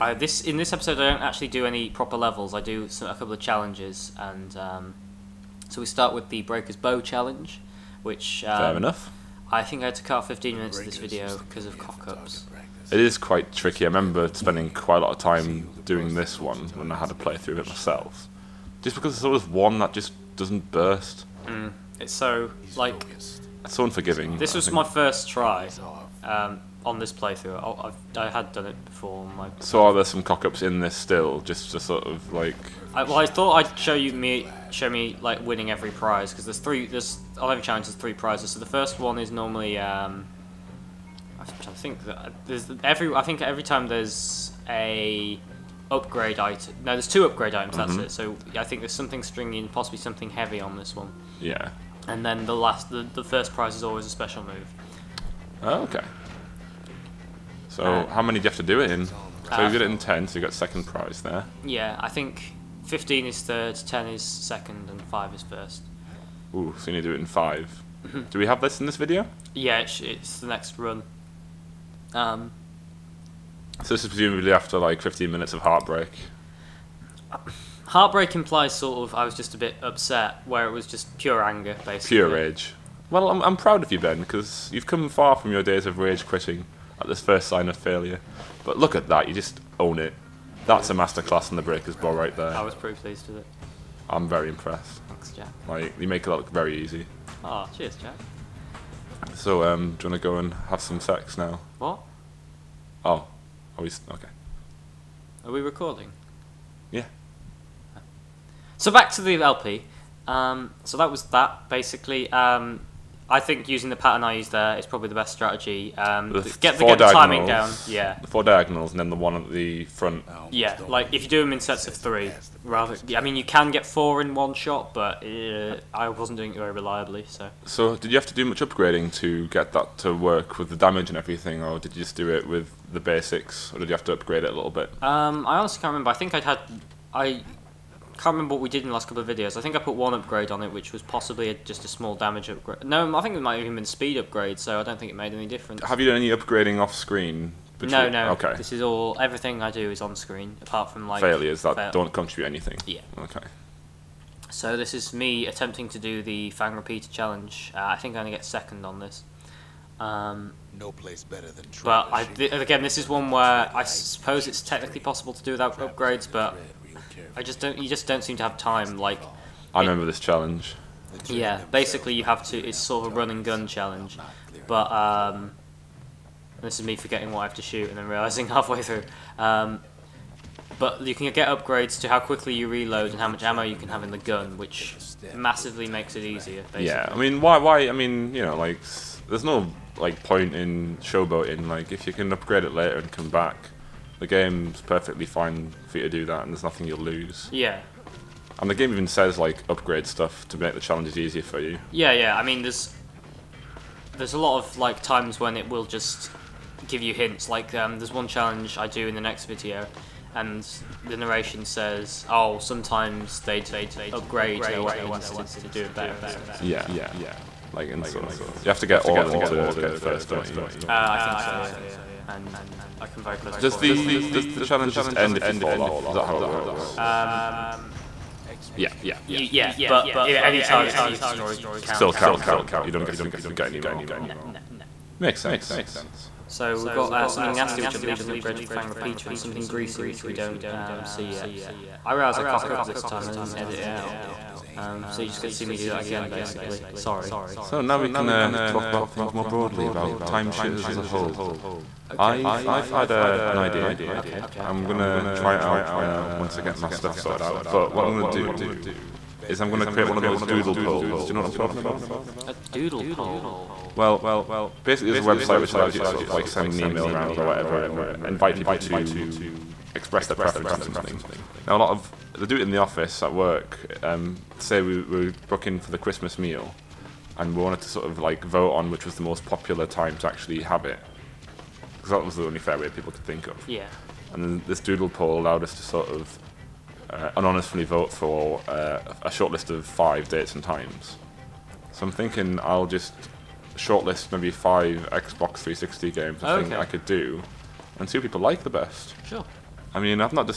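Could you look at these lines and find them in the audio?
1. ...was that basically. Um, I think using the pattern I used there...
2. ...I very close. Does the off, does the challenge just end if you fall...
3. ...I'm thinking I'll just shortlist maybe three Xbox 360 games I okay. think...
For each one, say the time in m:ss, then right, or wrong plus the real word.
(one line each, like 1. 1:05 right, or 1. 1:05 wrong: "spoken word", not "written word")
1. 1:51 right
2. 3:42 right
3. 4:52 wrong: "five", not "three".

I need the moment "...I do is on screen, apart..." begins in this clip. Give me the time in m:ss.
2:29.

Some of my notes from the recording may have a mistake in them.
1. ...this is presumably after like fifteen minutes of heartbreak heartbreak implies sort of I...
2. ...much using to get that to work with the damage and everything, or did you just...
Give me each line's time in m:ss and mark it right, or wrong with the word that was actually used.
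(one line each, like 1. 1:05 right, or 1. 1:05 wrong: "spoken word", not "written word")
1. 1:13 right
2. 2:08 wrong: "upgrading", not "using".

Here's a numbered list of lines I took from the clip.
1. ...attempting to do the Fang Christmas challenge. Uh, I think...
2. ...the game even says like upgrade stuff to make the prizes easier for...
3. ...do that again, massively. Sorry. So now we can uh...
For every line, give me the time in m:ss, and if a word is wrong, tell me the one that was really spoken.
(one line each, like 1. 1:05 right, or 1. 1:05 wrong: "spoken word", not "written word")
1. 2:35 wrong: "Repeater", not "Christmas"
2. 3:18 wrong: "challenges", not "prizes"
3. 4:05 wrong: "basically", not "massively".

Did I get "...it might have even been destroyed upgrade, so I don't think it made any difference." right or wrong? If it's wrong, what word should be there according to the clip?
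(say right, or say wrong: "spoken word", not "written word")
wrong: "speed", not "destroyed".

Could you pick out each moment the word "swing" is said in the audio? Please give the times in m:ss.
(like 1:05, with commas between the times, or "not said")
not said.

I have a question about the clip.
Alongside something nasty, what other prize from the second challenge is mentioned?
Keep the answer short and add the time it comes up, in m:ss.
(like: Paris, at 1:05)
something greasy, at 3:59.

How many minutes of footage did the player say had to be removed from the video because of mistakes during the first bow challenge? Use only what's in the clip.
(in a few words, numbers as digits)
15.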